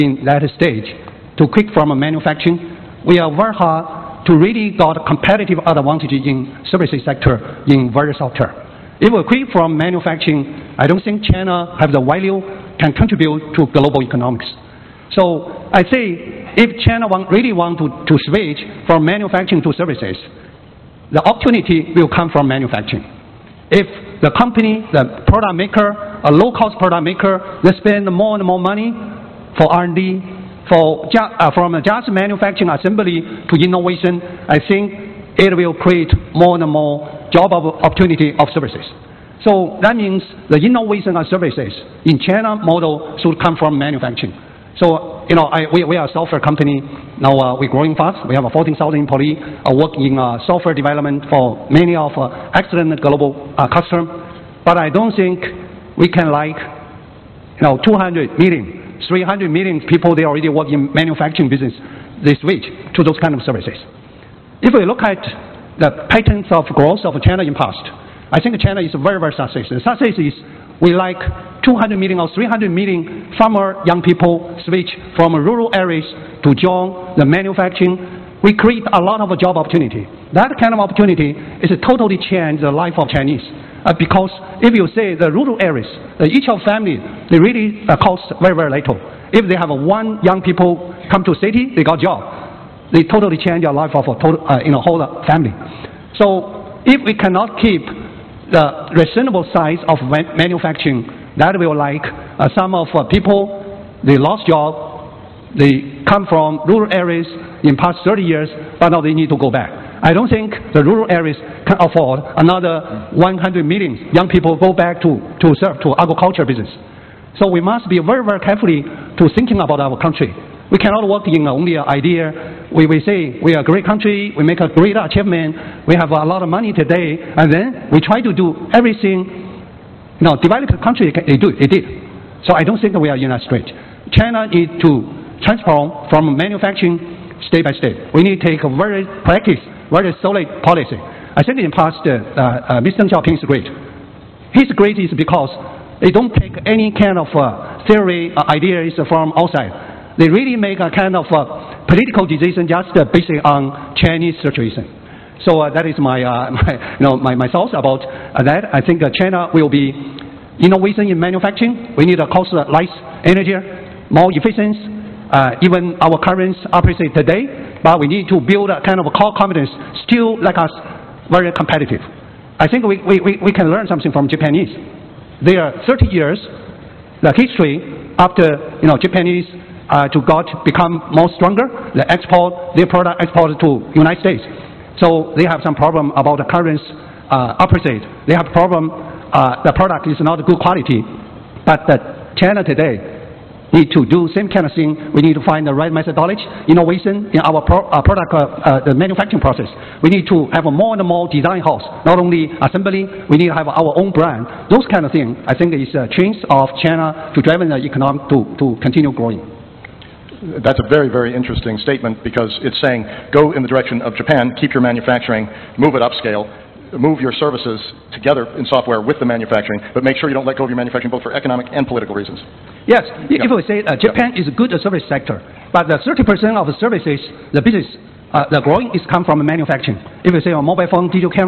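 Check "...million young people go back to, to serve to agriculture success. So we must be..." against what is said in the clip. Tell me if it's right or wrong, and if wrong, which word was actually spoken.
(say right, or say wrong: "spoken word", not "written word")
wrong: "business", not "success".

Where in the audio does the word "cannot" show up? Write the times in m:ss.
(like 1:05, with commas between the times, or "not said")
1:37, 2:00.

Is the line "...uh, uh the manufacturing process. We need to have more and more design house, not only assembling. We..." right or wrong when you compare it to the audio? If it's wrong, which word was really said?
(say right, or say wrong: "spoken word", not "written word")
right.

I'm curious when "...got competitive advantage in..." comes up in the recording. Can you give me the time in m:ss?
0:04.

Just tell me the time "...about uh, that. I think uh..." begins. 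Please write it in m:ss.
2:37.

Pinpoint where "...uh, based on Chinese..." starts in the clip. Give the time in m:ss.
2:32.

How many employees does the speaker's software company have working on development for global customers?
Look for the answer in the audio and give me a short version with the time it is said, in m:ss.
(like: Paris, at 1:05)
14,000, at 0:48.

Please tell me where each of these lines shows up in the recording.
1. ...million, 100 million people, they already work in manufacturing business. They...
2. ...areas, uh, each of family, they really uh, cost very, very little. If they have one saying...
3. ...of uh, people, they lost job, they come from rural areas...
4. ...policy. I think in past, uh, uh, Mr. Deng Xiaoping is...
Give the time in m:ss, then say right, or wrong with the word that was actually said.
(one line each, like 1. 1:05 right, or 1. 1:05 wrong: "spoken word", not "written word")
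1. 0:58 wrong: "300", not "100"
2. 1:25 wrong: "young", not "saying"
3. 1:42 right
4. 2:20 right.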